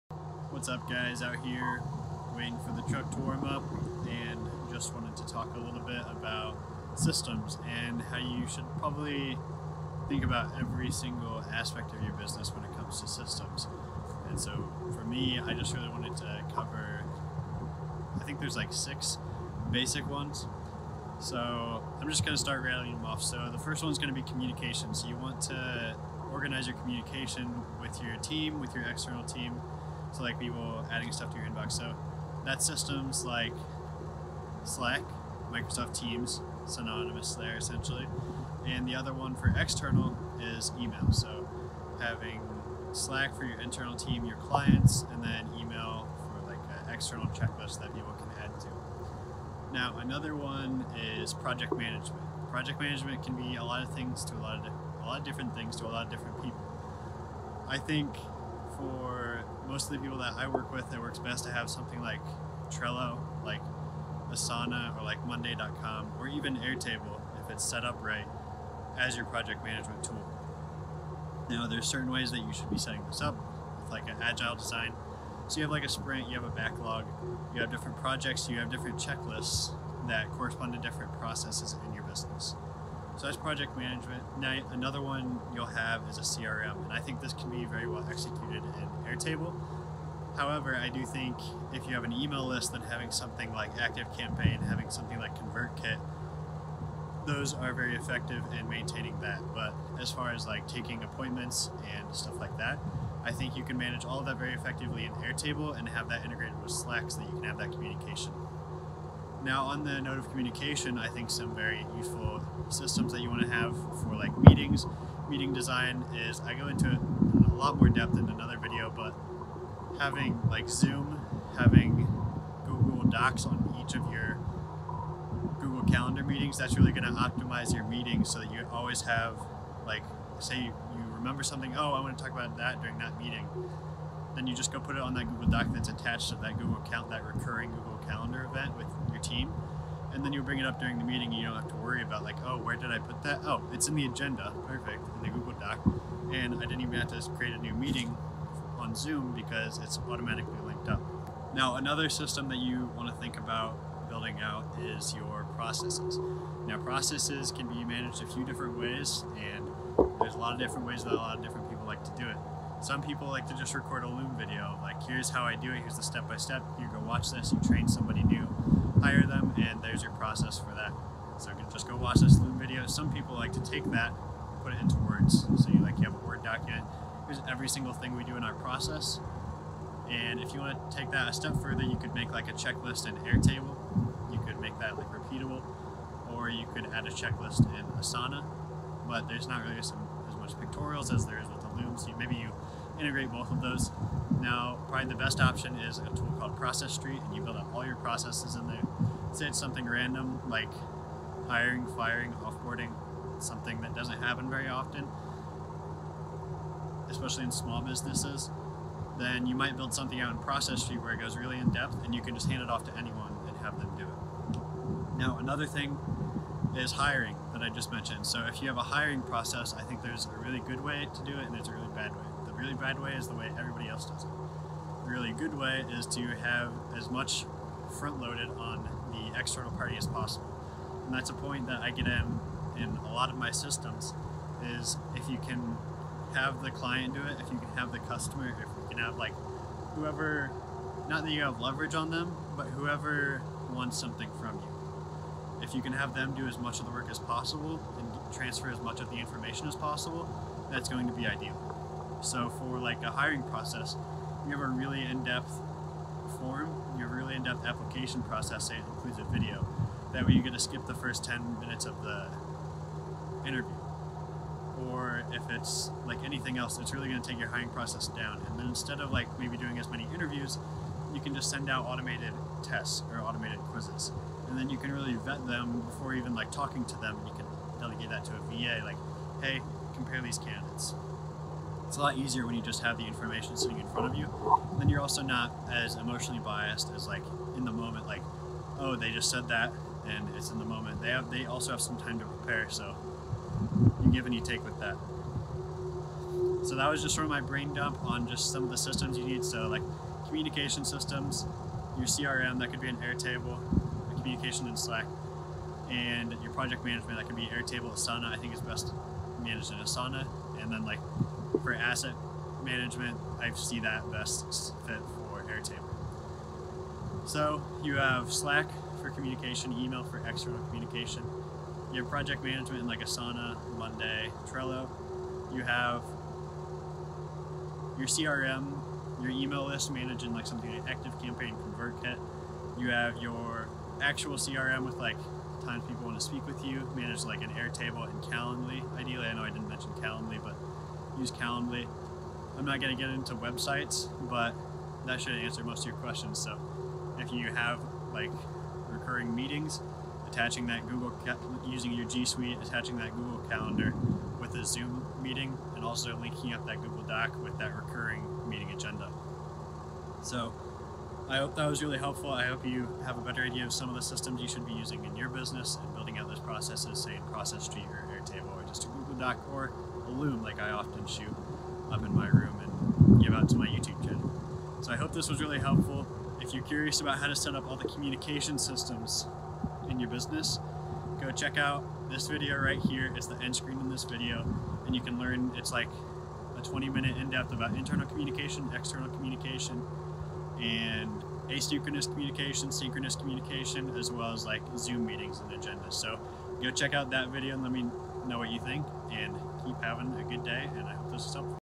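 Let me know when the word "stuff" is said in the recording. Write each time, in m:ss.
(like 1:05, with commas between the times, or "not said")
0:31, 1:42.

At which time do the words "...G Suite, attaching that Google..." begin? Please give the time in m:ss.
5:52.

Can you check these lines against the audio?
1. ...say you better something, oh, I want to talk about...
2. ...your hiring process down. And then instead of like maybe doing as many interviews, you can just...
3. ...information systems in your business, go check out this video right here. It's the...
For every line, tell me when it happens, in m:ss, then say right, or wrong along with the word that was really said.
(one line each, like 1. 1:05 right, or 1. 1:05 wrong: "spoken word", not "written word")
1. 2:10 wrong: "remember", not "better"
2. 4:27 right
3. 6:17 wrong: "communication", not "information".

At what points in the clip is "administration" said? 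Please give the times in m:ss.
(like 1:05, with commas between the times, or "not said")
not said.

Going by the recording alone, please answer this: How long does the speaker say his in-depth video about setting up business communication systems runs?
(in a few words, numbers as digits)
20 minutes.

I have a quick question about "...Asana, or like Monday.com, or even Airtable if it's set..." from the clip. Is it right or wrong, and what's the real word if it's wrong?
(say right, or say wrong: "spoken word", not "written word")
right.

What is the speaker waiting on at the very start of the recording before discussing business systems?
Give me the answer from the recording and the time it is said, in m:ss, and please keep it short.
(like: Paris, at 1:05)
the truck to warm up, at 0:02.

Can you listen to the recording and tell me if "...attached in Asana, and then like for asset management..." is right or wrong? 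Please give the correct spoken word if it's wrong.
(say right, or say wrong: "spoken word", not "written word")
wrong: "managed", not "attached".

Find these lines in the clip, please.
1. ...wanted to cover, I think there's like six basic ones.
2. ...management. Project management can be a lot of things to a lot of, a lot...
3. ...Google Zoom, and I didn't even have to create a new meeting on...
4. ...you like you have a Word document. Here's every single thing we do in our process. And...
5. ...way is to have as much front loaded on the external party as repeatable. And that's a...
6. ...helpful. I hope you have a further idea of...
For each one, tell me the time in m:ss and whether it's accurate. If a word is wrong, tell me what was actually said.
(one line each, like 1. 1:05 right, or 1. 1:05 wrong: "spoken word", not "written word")
1. 0:15 right
2. 0:51 right
3. 2:25 wrong: "Doc", not "Zoom"
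4. 2:55 right
5. 3:45 wrong: "possible", not "repeatable"
6. 6:01 wrong: "better", not "further".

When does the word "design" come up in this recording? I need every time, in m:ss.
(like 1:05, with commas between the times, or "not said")
1:14, 1:55.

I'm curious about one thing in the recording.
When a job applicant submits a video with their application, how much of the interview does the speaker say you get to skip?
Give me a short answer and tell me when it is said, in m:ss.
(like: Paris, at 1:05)
first 10 minutes, at 4:20.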